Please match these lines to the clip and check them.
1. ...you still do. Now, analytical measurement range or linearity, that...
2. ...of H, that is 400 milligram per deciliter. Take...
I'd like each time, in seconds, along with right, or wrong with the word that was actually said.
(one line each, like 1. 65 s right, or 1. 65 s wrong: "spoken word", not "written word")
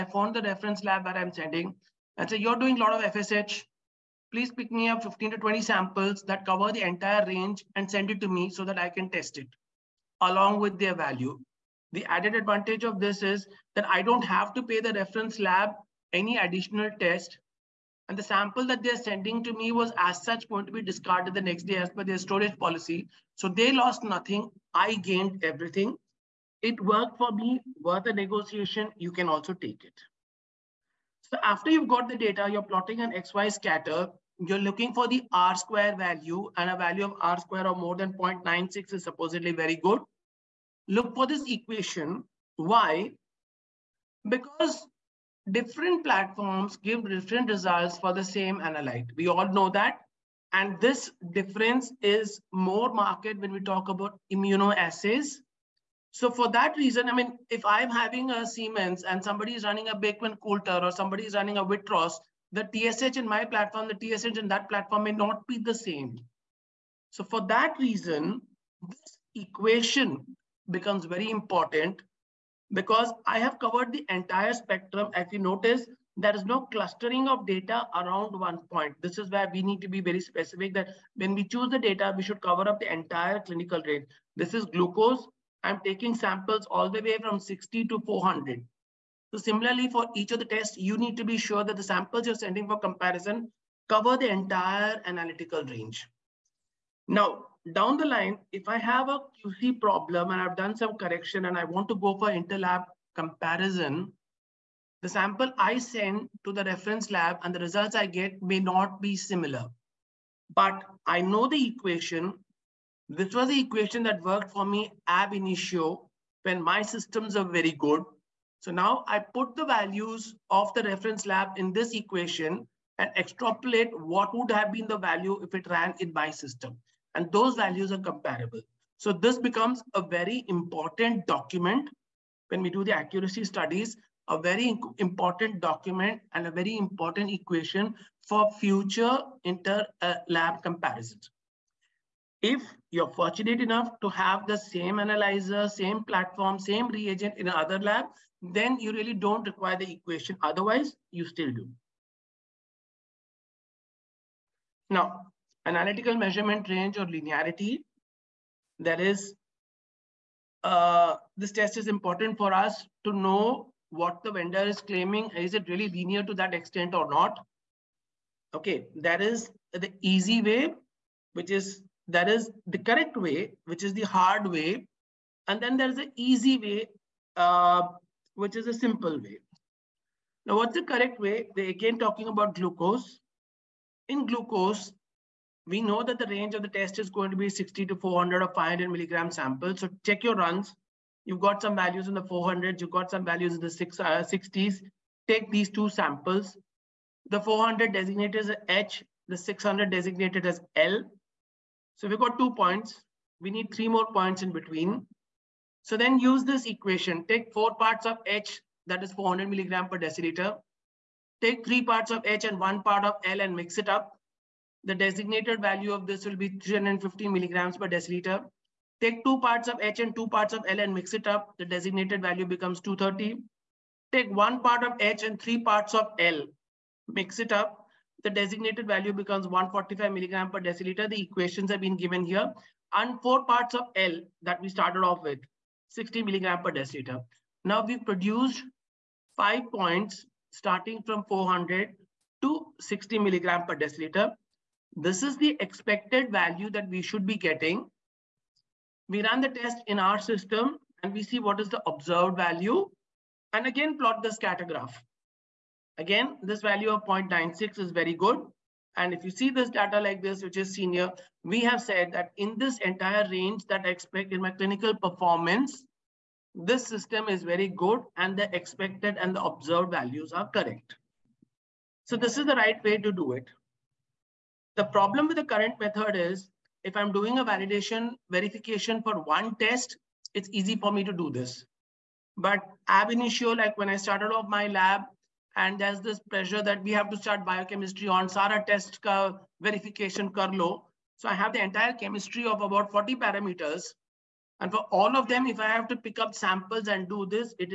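1. 151 s right
2. 208 s right.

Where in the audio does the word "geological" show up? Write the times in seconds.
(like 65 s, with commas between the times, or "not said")
not said.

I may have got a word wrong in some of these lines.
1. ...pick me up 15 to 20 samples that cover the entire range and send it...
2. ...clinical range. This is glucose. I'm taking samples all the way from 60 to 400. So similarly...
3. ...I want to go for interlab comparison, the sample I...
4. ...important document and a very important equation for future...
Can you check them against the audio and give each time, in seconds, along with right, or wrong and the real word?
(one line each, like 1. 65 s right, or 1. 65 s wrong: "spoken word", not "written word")
1. 4 s right
2. 83 s right
3. 101 s right
4. 134 s right.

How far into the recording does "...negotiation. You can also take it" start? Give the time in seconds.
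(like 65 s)
28 s.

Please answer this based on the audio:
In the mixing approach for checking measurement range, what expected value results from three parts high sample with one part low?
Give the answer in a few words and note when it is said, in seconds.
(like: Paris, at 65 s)
350 mg/dL, at 216 s.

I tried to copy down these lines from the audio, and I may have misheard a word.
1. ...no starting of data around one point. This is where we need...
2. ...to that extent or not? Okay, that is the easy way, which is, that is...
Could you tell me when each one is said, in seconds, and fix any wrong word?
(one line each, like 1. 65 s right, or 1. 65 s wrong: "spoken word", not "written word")
1. 76 s wrong: "clustering", not "starting"
2. 166 s right.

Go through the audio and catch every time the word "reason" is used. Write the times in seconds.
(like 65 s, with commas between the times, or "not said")
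56 s, 67 s.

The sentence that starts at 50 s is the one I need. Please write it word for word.
And this difference is more marked when we talk about immunoassays.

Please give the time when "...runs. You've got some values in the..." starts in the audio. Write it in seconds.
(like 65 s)
190 s.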